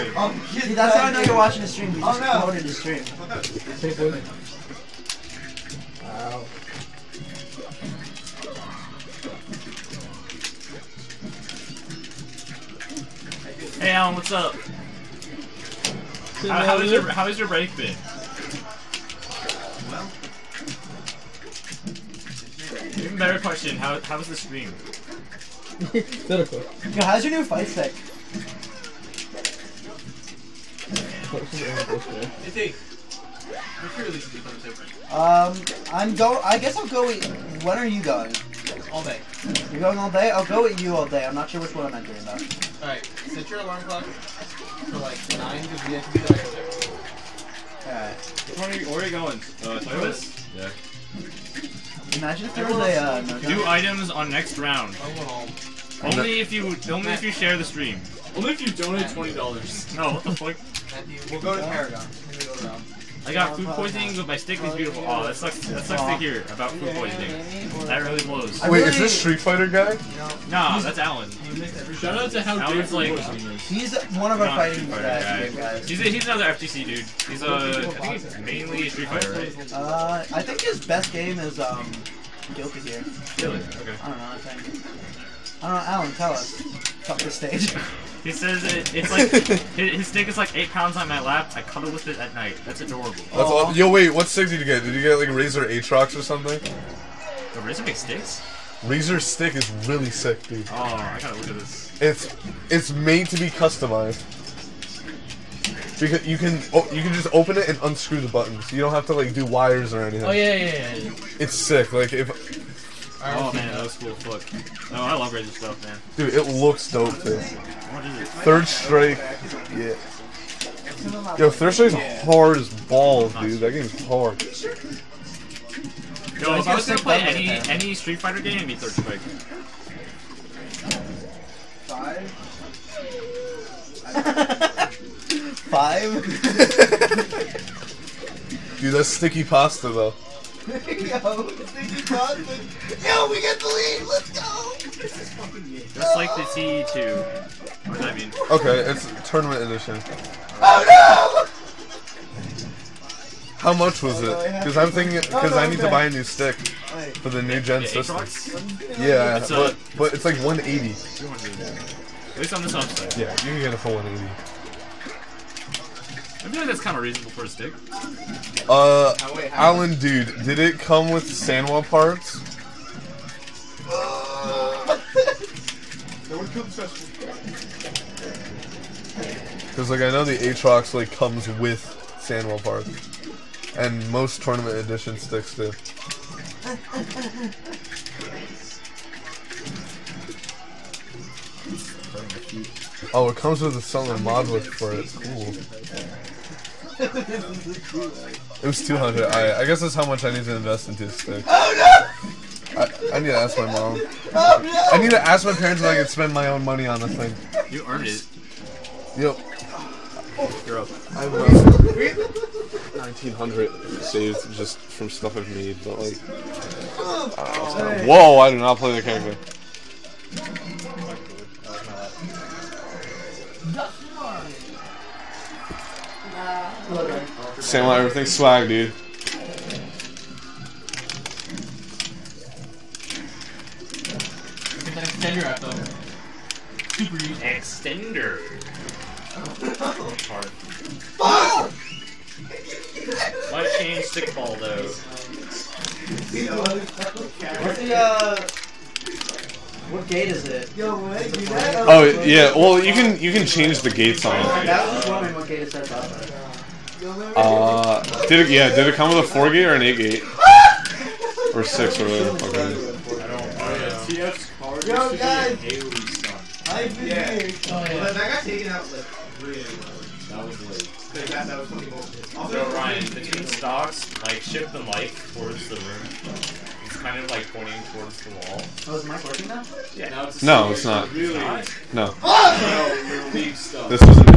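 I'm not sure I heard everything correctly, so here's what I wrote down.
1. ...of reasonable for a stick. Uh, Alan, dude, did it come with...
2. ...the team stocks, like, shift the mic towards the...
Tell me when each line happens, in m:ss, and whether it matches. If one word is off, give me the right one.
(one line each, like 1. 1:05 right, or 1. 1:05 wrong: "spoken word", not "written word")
1. 2:46 right
2. 4:33 right.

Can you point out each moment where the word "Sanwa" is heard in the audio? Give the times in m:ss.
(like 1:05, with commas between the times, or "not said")
2:51, 3:02.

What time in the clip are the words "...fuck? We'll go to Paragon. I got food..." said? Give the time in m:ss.
1:00.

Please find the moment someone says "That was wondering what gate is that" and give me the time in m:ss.
4:14.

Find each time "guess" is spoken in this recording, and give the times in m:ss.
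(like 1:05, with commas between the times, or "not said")
0:36, 3:19.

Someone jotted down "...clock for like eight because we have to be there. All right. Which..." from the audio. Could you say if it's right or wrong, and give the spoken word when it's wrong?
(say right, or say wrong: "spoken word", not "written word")
wrong: "nine", not "eight".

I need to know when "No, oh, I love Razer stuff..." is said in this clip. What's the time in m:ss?
1:54.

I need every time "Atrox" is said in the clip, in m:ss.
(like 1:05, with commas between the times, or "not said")
1:35, 3:00.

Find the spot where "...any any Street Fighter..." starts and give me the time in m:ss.
2:07.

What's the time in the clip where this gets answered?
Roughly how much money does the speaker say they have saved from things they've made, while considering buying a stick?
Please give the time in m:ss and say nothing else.
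3:32.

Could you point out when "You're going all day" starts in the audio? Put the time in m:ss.
0:39.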